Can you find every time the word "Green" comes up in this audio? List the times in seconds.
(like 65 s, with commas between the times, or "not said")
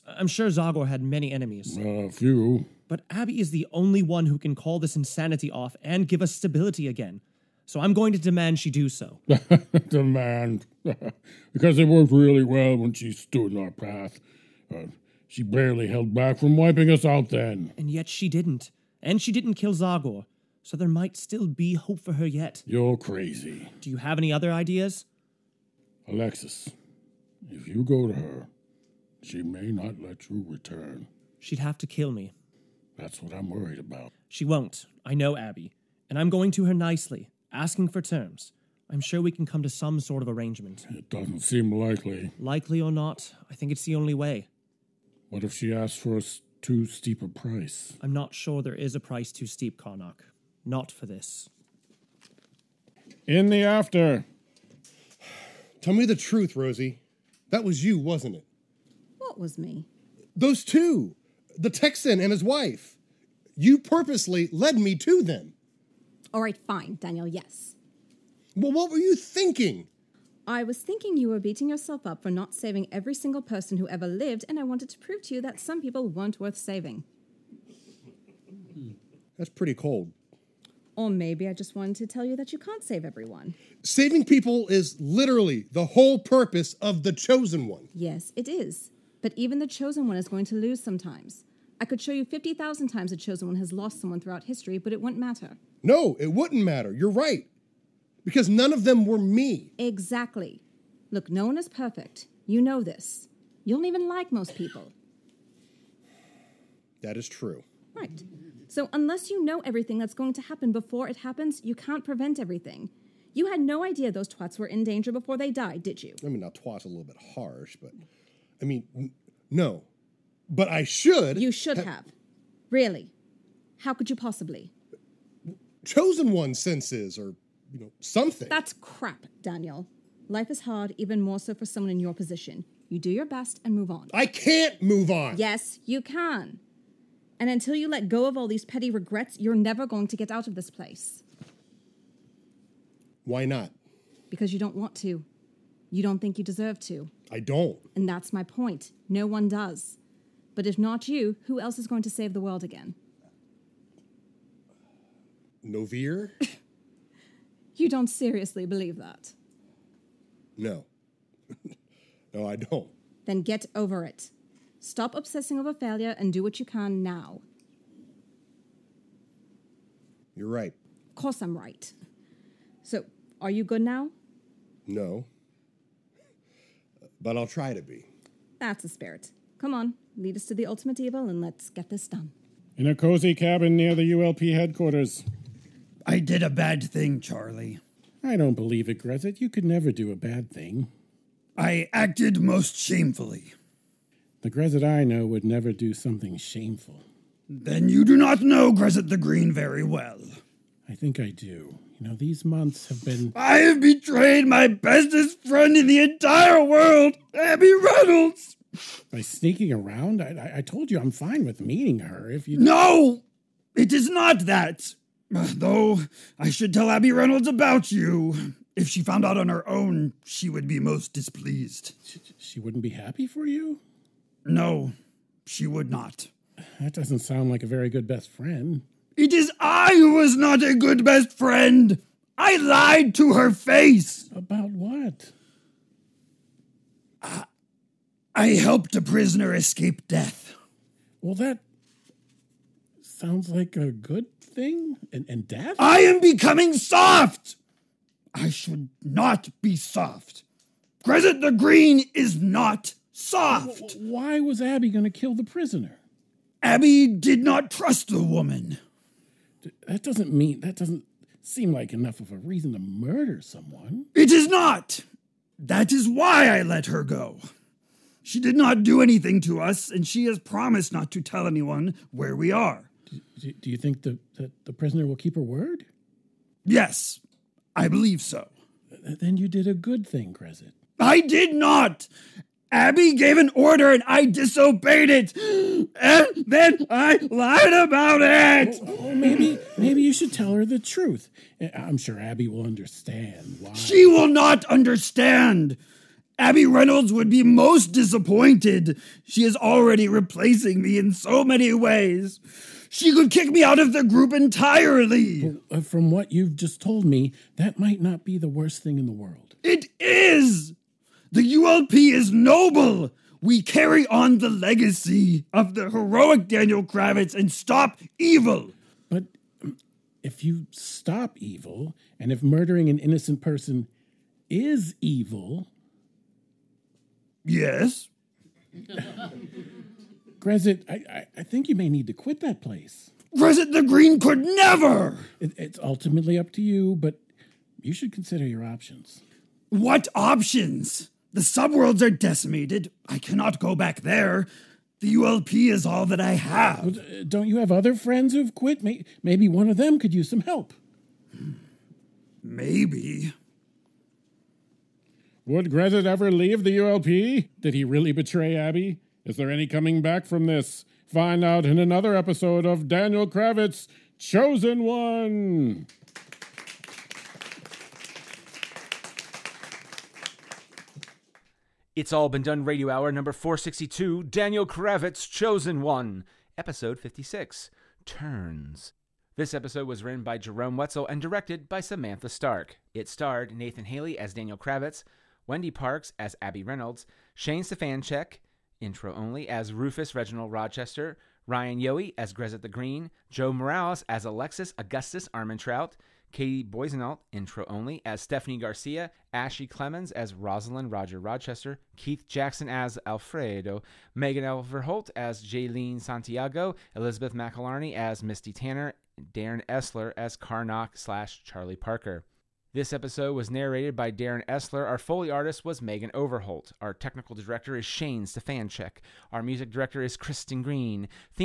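199 s, 251 s, 333 s, 392 s, 420 s.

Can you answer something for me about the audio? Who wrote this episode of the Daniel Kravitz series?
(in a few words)
Jerome Wetzel.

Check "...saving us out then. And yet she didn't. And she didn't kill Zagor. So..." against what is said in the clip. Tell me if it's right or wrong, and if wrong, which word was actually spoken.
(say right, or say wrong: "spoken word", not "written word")
wrong: "wiping", not "saving".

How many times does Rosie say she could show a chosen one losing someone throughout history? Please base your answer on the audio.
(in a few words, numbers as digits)
50,000.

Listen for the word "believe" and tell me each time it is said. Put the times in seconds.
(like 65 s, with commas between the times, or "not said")
158 s, 188 s, 277 s.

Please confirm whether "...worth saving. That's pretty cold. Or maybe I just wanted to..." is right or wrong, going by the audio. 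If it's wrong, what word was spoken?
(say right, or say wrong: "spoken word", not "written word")
right.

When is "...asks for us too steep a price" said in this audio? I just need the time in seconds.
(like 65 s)
45 s.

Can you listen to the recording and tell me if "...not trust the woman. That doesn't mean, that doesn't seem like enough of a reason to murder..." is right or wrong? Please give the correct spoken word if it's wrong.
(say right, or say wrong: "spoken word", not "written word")
right.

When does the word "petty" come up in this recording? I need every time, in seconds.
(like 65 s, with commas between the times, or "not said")
138 s.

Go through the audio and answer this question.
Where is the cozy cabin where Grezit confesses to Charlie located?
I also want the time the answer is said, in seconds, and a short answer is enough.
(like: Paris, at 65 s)
Near the ULP headquarters, at 183 s.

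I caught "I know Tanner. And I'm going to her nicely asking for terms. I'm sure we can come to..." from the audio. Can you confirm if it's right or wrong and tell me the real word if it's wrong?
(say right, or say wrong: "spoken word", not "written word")
wrong: "Abby", not "Tanner".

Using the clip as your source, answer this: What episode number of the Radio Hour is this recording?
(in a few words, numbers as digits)
462.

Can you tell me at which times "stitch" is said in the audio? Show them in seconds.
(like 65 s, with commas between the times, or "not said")
not said.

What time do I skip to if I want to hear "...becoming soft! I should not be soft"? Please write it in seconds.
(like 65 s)
246 s.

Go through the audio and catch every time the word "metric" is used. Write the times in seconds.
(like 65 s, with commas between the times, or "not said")
not said.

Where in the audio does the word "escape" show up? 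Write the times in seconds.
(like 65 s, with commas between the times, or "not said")
239 s.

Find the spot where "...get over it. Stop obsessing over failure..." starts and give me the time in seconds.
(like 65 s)
163 s.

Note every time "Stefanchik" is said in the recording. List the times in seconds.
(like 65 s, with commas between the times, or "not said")
387 s, 418 s.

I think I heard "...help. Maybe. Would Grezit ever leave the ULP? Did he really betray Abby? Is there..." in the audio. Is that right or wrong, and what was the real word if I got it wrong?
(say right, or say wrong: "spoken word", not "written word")
right.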